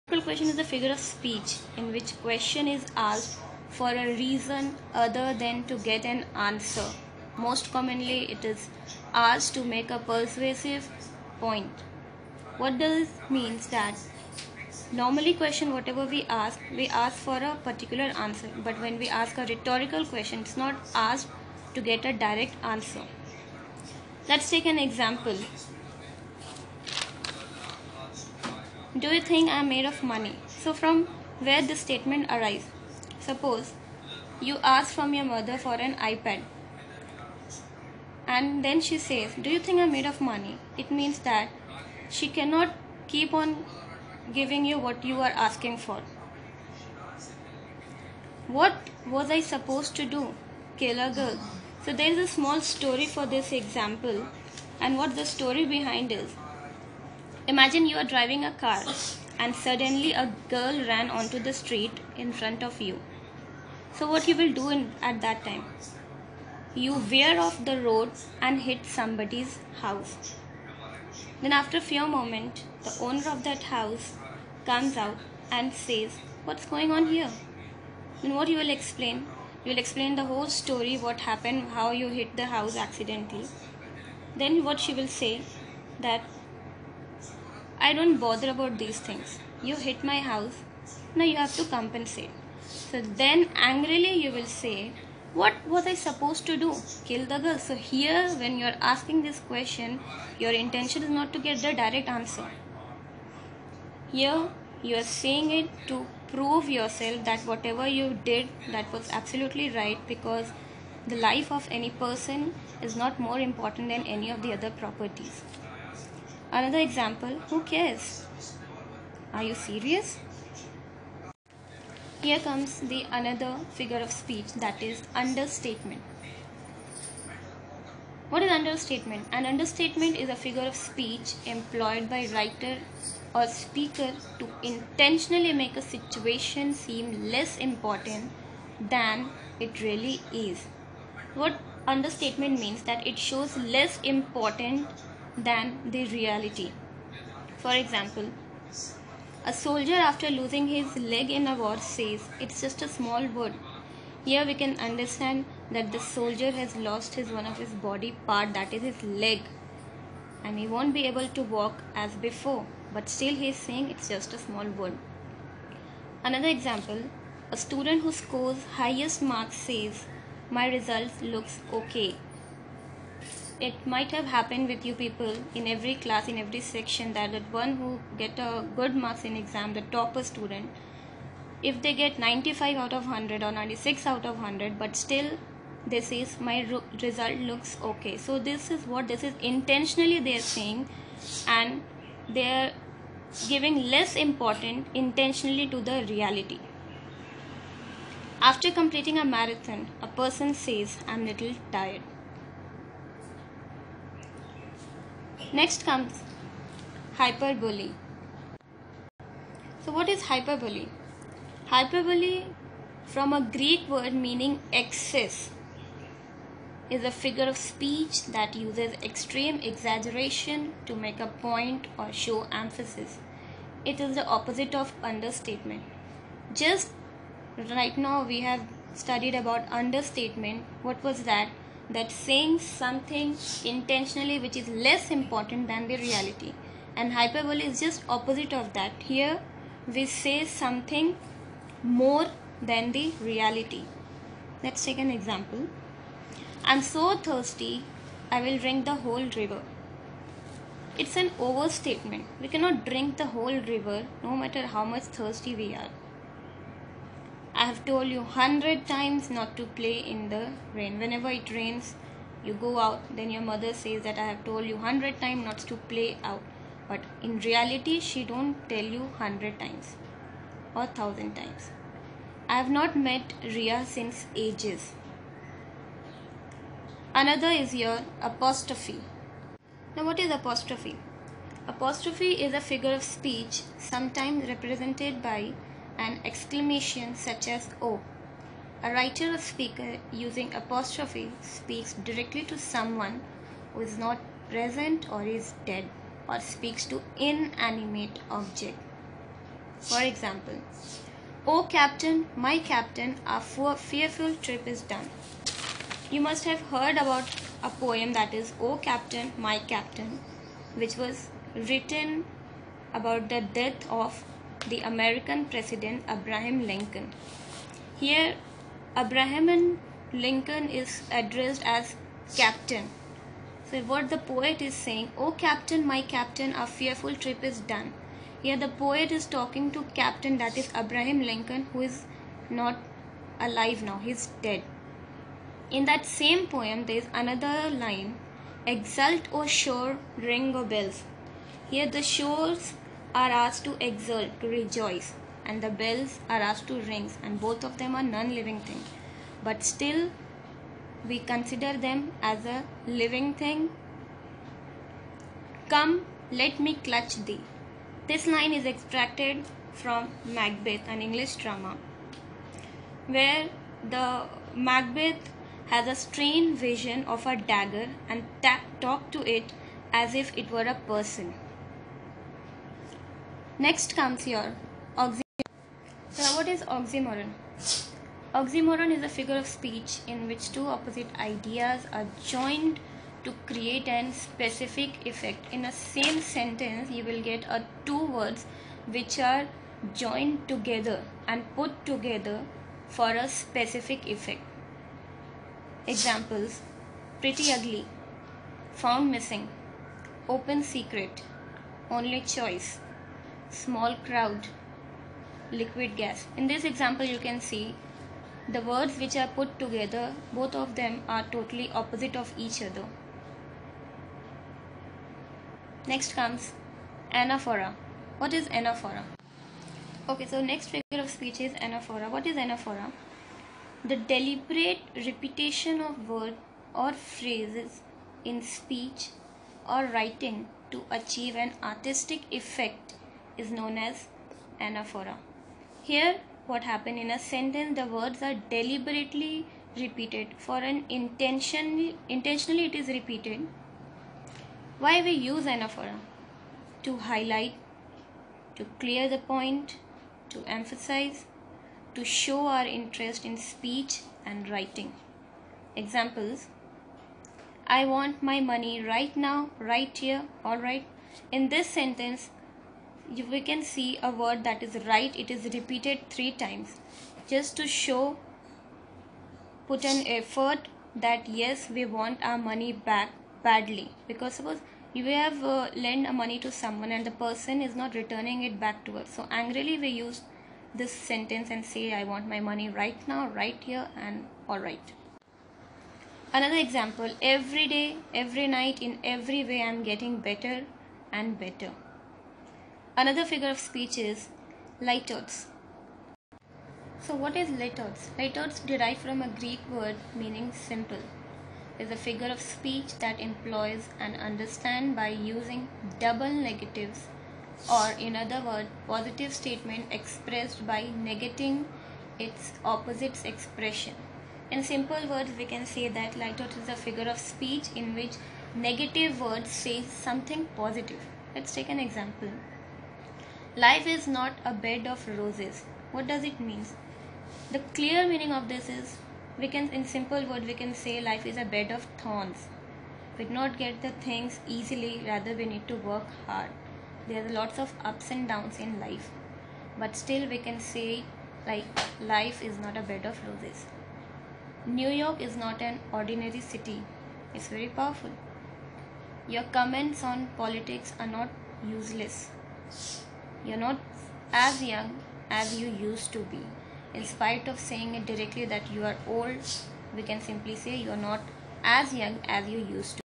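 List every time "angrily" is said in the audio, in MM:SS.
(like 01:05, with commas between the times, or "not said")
01:33, 07:59.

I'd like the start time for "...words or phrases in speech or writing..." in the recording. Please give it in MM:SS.
07:06.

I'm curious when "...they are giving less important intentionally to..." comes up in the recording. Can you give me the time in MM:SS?
03:12.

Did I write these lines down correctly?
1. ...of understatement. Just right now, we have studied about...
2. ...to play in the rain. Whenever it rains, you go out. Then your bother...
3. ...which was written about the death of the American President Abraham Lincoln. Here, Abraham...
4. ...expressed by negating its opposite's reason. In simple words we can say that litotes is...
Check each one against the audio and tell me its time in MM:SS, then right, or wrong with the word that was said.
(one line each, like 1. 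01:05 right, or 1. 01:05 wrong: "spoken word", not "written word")
1. 03:44 right
2. 04:19 wrong: "mother", not "bother"
3. 05:10 right
4. 08:29 wrong: "expression", not "reason".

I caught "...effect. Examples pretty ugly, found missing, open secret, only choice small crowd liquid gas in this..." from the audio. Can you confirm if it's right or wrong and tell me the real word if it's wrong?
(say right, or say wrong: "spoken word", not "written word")
right.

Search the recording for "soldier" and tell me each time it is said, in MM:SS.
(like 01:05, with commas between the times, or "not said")
02:29, 02:35.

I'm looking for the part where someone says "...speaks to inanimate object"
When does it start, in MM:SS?
04:56.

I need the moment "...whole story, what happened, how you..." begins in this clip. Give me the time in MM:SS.
01:20.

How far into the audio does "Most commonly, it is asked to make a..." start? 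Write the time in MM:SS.
00:07.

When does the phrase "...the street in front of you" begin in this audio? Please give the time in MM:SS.
01:01.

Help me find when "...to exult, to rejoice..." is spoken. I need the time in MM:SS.
05:43.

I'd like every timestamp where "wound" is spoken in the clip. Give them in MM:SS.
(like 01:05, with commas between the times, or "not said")
02:33, 02:44.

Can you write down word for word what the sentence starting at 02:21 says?
What understatement means that it shows less important than the reality.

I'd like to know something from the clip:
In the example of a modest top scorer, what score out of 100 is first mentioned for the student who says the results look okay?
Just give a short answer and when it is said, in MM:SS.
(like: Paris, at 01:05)
95, at 03:02.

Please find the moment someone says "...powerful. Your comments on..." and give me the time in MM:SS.
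09:07.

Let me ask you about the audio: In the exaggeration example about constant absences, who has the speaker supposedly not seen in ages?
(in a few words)
Ria.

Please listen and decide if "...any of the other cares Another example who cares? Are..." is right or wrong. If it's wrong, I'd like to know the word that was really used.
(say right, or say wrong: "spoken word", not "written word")
wrong: "properties", not "cares".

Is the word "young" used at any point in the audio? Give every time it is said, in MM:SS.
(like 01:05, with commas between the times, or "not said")
09:14, 09:21.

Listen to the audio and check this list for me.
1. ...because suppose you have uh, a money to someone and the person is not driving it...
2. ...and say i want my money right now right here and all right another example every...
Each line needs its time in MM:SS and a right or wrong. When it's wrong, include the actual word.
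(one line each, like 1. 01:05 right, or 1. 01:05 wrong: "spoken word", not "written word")
1. 07:54 wrong: "returning", not "driving"
2. 08:01 right.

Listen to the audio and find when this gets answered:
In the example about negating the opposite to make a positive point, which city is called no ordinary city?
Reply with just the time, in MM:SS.
09:04.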